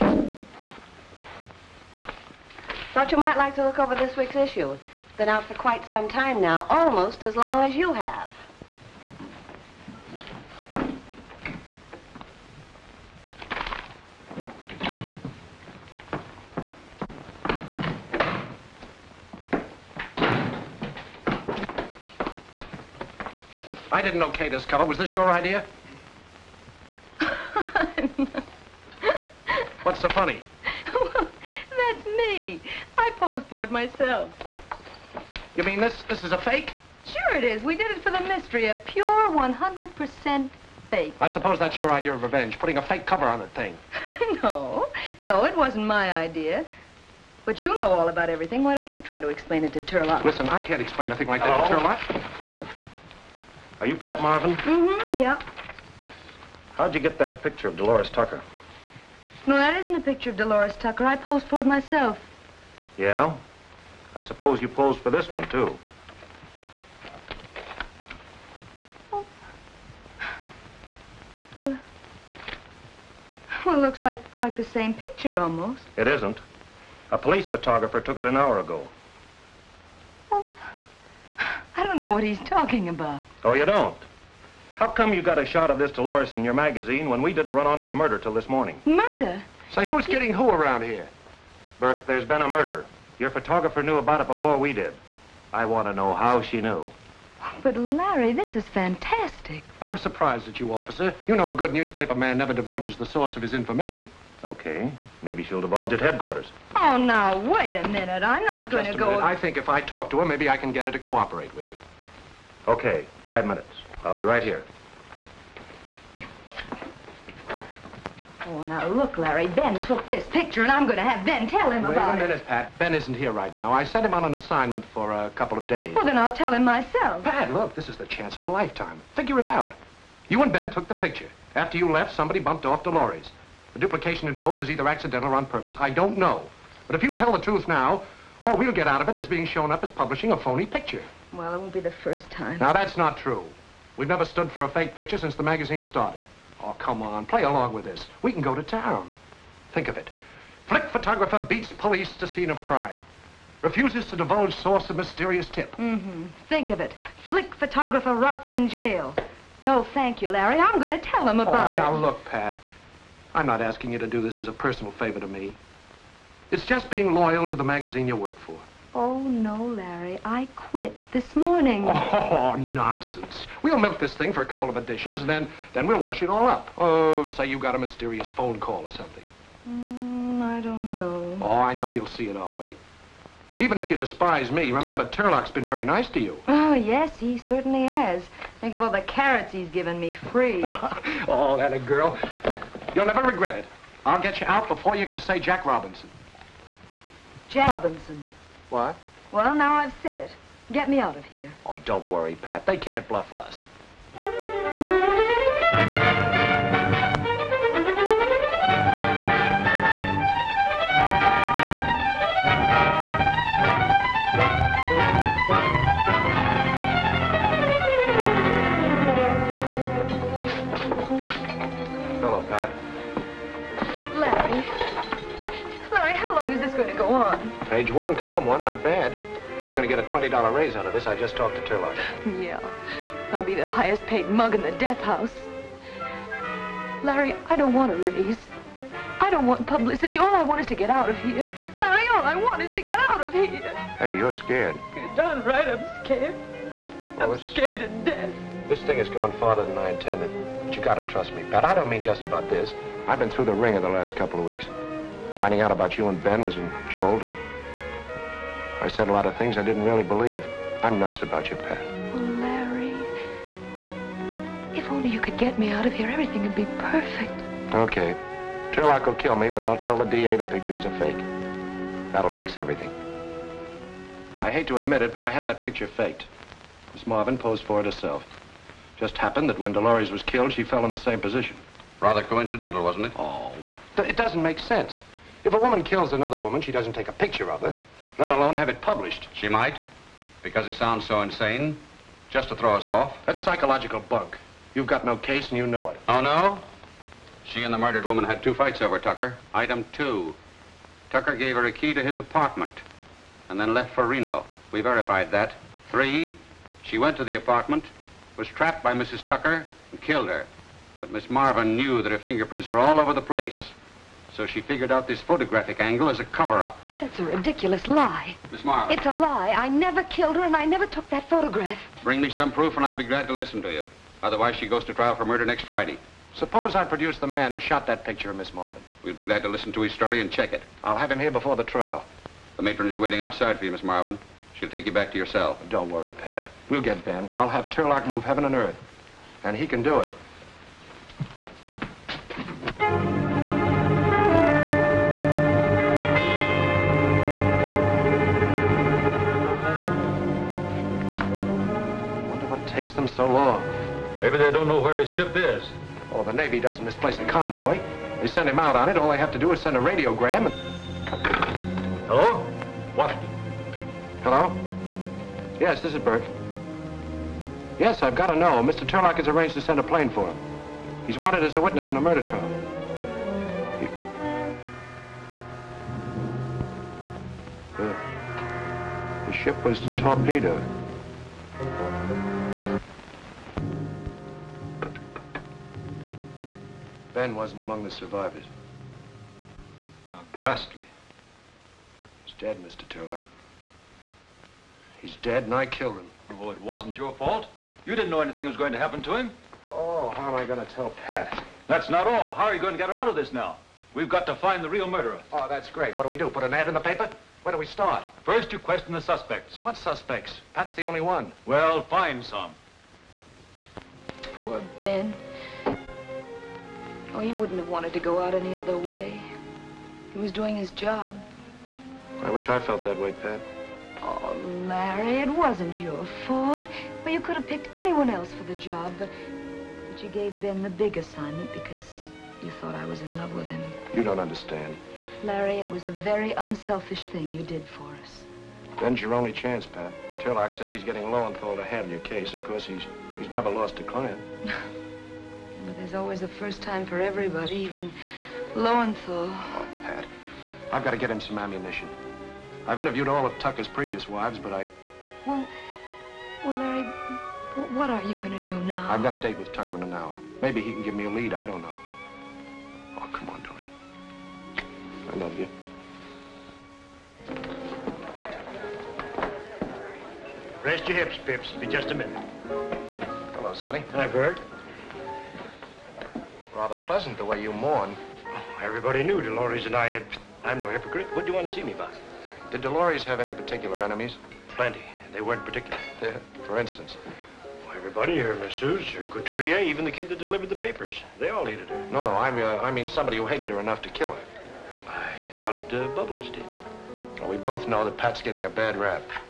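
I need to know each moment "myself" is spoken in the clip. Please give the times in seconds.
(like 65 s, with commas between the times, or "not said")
33 s, 61 s, 126 s.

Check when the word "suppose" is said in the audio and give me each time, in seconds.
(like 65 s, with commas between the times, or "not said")
41 s, 64 s, 326 s.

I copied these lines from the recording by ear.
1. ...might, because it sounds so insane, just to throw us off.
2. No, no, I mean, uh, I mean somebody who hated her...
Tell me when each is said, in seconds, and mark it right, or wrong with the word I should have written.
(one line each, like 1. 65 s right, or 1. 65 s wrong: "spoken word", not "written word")
1. 289 s right
2. 491 s right.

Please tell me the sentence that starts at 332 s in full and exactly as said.
The matron is waiting outside for you, Miss Marvin.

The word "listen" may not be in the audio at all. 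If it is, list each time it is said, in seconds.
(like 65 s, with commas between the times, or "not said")
50 s, 323 s, 329 s.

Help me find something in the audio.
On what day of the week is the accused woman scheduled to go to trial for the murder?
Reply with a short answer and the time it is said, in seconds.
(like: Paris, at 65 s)
Friday, at 325 s.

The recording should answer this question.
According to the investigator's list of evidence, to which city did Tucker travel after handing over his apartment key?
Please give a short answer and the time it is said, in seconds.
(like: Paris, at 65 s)
Reno, at 304 s.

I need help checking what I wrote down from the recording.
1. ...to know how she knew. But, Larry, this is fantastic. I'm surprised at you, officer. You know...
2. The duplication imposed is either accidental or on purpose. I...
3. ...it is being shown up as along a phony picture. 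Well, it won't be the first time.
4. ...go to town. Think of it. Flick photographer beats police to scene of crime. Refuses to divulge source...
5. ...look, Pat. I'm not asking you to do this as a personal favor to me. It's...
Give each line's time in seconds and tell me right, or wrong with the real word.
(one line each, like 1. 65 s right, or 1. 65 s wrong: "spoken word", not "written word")
1. 95 s right
2. 133 s right
3. 139 s wrong: "publishing", not "along"
4. 148 s right
5. 162 s right.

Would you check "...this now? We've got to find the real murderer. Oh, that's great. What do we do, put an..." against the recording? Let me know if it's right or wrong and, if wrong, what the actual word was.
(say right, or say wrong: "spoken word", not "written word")
right.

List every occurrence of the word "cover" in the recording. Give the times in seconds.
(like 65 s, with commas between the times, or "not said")
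24 s, 43 s, 316 s.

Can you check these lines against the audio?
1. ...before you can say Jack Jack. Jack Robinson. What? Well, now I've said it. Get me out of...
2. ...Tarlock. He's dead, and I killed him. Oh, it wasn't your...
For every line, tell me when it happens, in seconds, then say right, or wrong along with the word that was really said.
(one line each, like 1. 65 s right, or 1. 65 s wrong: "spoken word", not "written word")
1. 194 s wrong: "Robinson", not "Jack"
2. 392 s right.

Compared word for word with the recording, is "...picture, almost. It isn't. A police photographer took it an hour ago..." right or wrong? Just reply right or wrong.
right.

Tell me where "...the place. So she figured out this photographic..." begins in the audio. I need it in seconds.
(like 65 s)
313 s.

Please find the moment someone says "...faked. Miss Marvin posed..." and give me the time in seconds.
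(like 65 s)
275 s.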